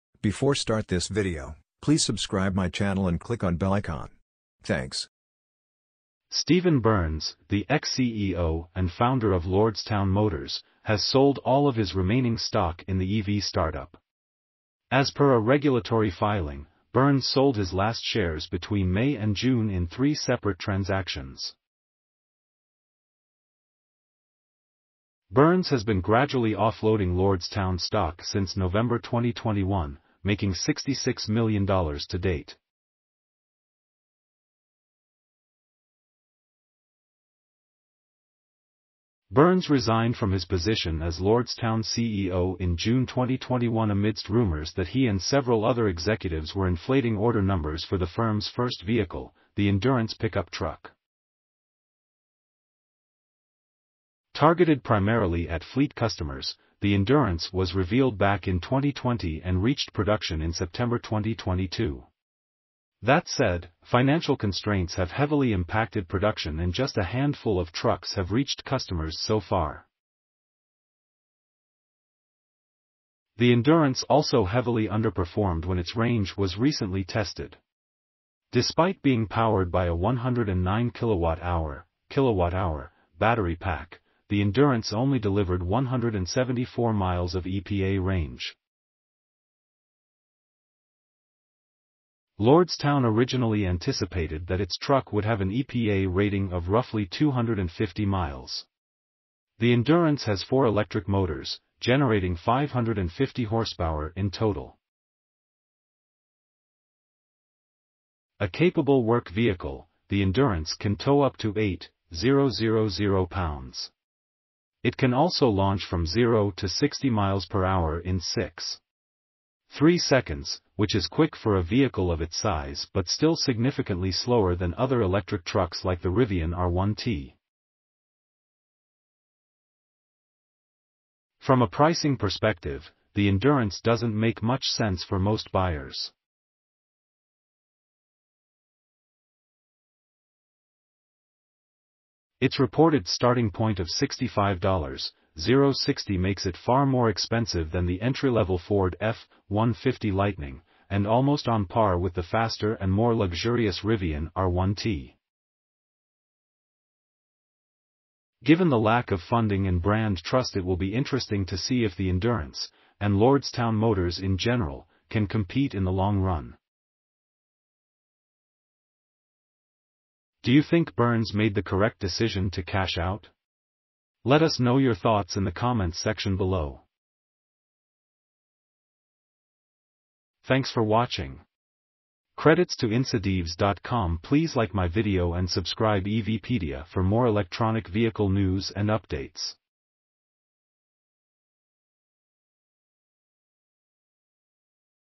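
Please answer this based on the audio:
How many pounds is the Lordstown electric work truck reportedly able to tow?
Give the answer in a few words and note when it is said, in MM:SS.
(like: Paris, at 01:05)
8,000 pounds, at 01:51.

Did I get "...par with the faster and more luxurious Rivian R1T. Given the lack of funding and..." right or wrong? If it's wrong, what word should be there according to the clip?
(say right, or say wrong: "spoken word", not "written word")
right.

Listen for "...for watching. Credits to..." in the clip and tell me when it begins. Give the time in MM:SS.
03:00.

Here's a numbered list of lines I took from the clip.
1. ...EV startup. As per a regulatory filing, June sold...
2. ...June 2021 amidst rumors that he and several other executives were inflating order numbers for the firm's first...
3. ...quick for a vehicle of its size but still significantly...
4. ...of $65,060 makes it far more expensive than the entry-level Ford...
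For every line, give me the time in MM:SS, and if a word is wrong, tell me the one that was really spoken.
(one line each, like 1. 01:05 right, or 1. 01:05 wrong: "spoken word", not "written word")
1. 00:13 wrong: "Burns", not "June"
2. 00:42 right
3. 02:01 right
4. 02:23 right.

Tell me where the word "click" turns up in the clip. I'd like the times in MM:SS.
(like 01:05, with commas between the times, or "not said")
00:03.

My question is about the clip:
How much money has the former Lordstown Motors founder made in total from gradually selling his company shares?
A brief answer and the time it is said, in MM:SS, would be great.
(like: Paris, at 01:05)
$66 million, at 00:30.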